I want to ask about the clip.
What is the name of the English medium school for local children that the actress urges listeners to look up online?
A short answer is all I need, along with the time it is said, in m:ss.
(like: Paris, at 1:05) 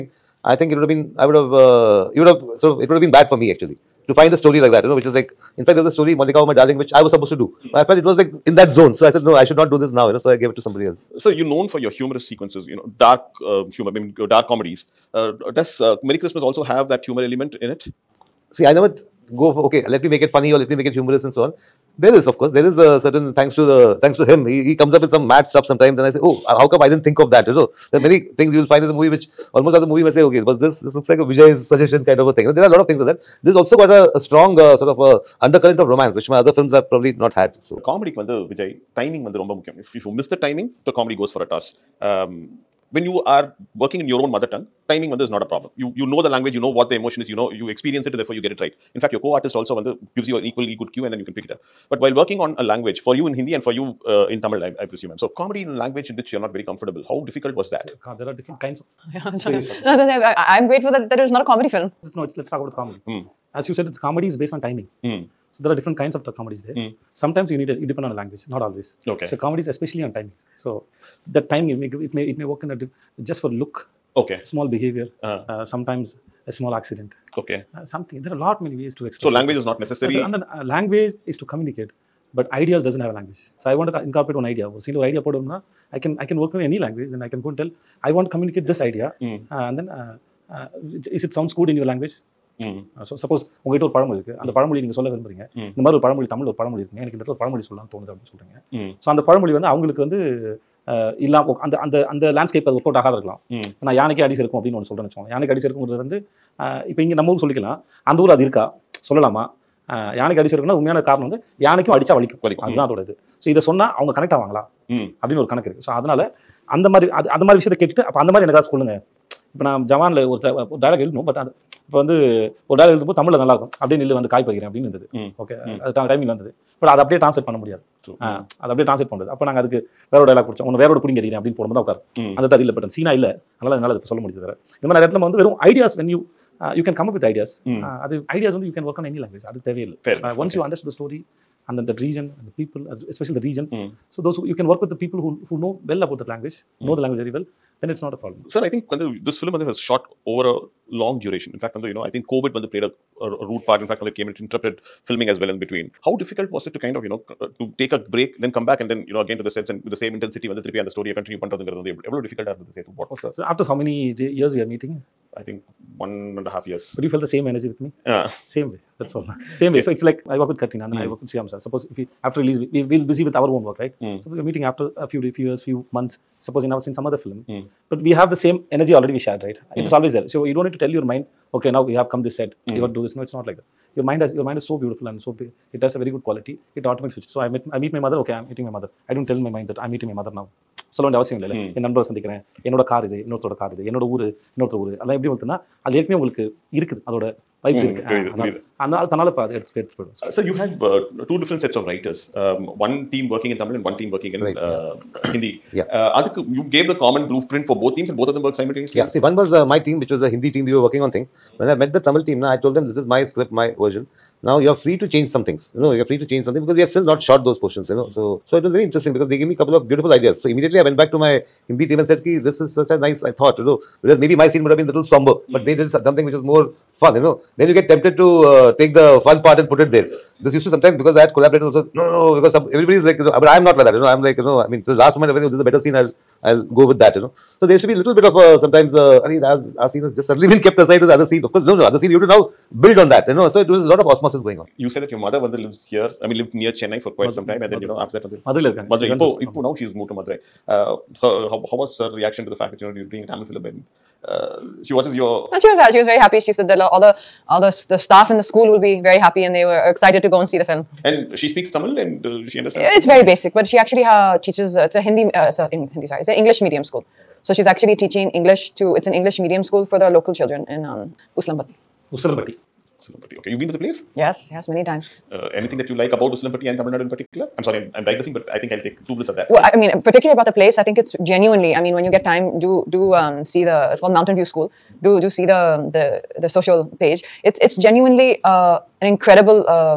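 Mountain View School, at 4:44.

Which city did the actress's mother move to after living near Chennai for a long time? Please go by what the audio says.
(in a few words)
Madurai.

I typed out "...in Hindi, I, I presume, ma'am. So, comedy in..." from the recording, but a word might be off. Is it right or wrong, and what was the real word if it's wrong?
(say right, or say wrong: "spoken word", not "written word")
wrong: "Tamil", not "Hindi".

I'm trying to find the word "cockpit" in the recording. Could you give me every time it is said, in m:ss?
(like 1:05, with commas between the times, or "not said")
not said.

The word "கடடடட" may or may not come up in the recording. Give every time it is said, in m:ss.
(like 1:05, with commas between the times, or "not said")
1:57.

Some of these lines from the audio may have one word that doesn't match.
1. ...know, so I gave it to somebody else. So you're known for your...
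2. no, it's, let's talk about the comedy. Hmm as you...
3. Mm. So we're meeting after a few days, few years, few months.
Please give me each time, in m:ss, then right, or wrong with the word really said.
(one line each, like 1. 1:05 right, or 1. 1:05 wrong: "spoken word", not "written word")
1. 0:10 right
2. 1:02 right
3. 2:54 right.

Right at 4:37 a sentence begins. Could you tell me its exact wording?
I'm sorry, I'm, I'm digressing, but I think I'll take two minutes of that.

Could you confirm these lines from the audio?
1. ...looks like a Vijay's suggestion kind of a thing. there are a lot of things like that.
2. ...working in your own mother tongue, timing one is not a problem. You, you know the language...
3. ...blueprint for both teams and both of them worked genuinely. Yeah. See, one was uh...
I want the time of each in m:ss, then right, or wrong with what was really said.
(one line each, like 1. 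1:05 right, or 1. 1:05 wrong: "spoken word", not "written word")
1. 0:30 right
2. 0:43 right
3. 3:27 wrong: "simultaneously", not "genuinely".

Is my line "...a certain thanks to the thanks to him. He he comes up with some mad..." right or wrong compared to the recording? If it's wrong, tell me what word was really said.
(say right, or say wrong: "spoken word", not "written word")
right.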